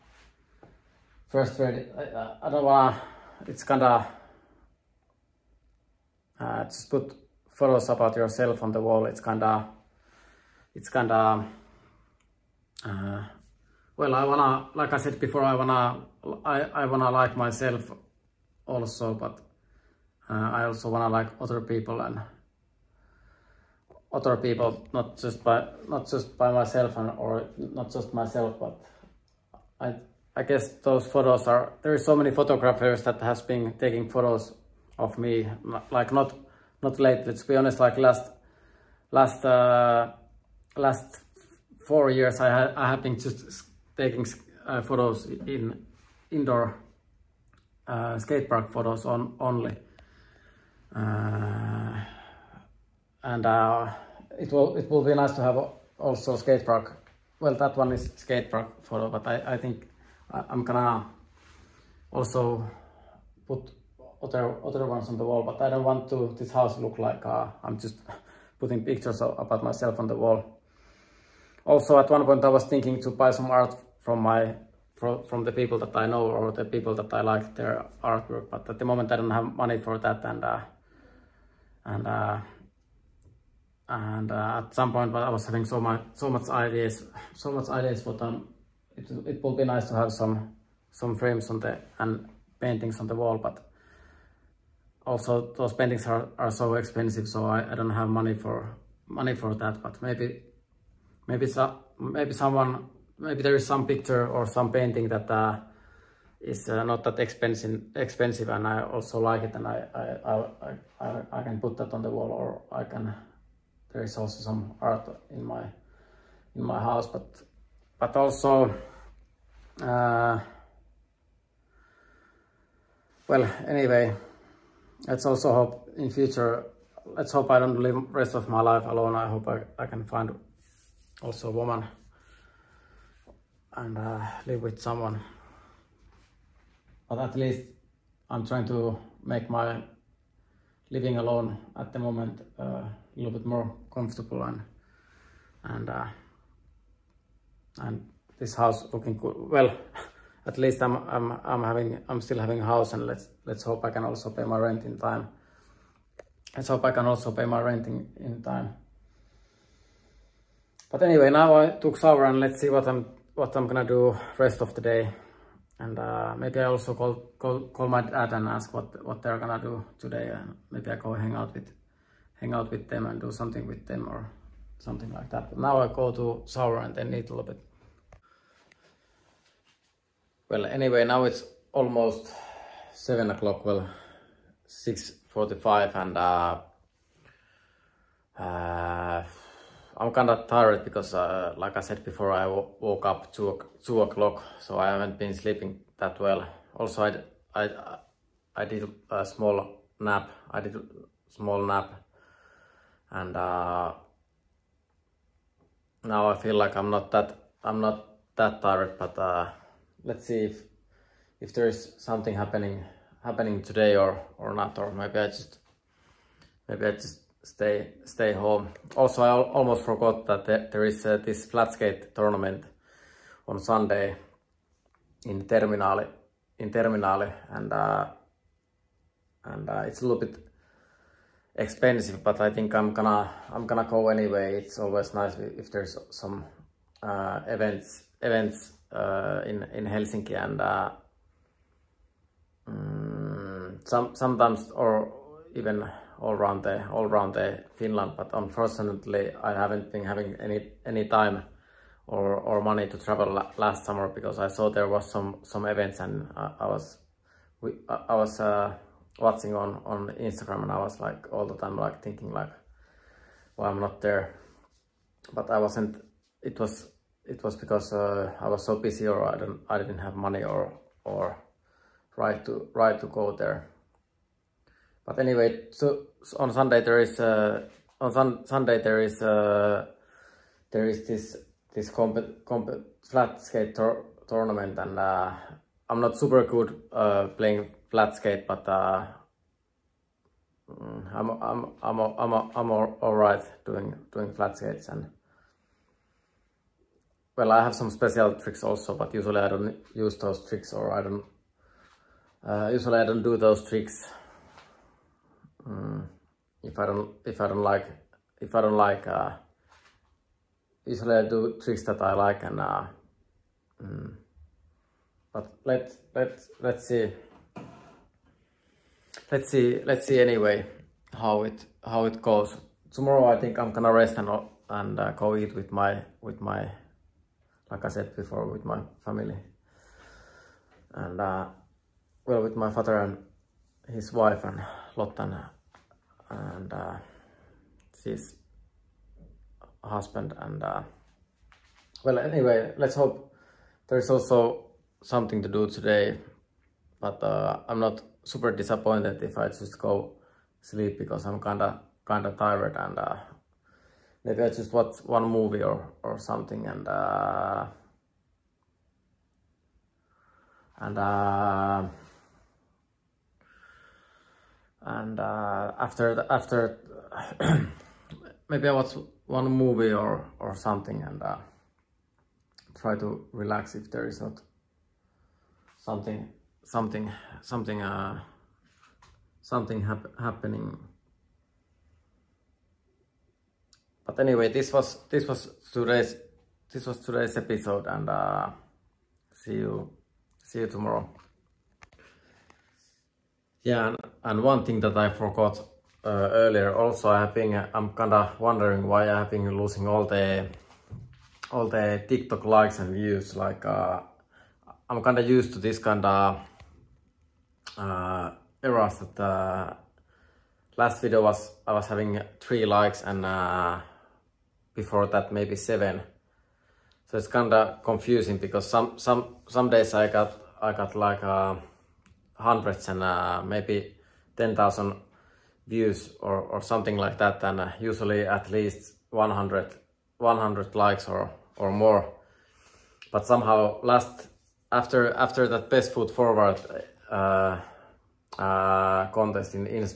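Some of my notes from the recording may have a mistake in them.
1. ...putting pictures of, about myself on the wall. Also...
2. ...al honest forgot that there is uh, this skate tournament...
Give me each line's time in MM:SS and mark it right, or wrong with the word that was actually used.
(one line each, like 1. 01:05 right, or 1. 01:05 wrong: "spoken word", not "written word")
1. 01:08 right
2. 03:39 wrong: "almost", not "honest".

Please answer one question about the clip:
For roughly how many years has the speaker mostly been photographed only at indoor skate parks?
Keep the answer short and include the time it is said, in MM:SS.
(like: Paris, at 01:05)
4 years, at 00:40.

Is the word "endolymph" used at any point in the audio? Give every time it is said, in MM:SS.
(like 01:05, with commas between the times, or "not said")
not said.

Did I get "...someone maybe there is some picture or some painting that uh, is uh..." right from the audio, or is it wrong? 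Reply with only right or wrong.
right.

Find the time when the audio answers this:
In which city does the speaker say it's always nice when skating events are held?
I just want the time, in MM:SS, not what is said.
03:59.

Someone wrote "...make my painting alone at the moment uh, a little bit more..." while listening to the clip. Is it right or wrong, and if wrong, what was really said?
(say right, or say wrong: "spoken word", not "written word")
wrong: "living", not "painting".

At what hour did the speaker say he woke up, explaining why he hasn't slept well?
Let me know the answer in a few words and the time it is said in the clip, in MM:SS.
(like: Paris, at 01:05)
2 o'clock, at 03:13.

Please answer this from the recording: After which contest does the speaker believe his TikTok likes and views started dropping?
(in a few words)
Best Foot Forward.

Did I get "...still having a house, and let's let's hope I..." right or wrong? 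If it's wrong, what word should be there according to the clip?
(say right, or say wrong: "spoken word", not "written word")
right.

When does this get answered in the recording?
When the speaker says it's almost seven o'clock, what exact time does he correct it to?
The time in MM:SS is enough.
03:04.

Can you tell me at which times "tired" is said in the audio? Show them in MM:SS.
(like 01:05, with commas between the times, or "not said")
03:10, 03:28, 05:52.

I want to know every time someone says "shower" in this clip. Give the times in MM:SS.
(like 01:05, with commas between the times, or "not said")
02:41.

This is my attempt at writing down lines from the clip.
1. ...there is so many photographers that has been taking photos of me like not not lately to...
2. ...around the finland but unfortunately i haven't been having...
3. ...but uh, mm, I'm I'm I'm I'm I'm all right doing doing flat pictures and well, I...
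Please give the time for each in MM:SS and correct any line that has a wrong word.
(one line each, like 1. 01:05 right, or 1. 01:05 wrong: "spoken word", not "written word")
1. 00:31 right
2. 04:07 right
3. 04:48 wrong: "skates", not "pictures".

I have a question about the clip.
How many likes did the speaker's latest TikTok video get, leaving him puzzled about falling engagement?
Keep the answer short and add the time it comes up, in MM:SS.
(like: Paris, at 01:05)
3, at 06:52.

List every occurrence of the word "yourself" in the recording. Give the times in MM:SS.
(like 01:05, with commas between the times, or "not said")
00:08.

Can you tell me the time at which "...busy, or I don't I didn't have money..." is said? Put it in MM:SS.
04:28.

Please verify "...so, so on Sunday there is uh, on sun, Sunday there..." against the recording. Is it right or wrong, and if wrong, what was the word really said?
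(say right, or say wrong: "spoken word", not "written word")
right.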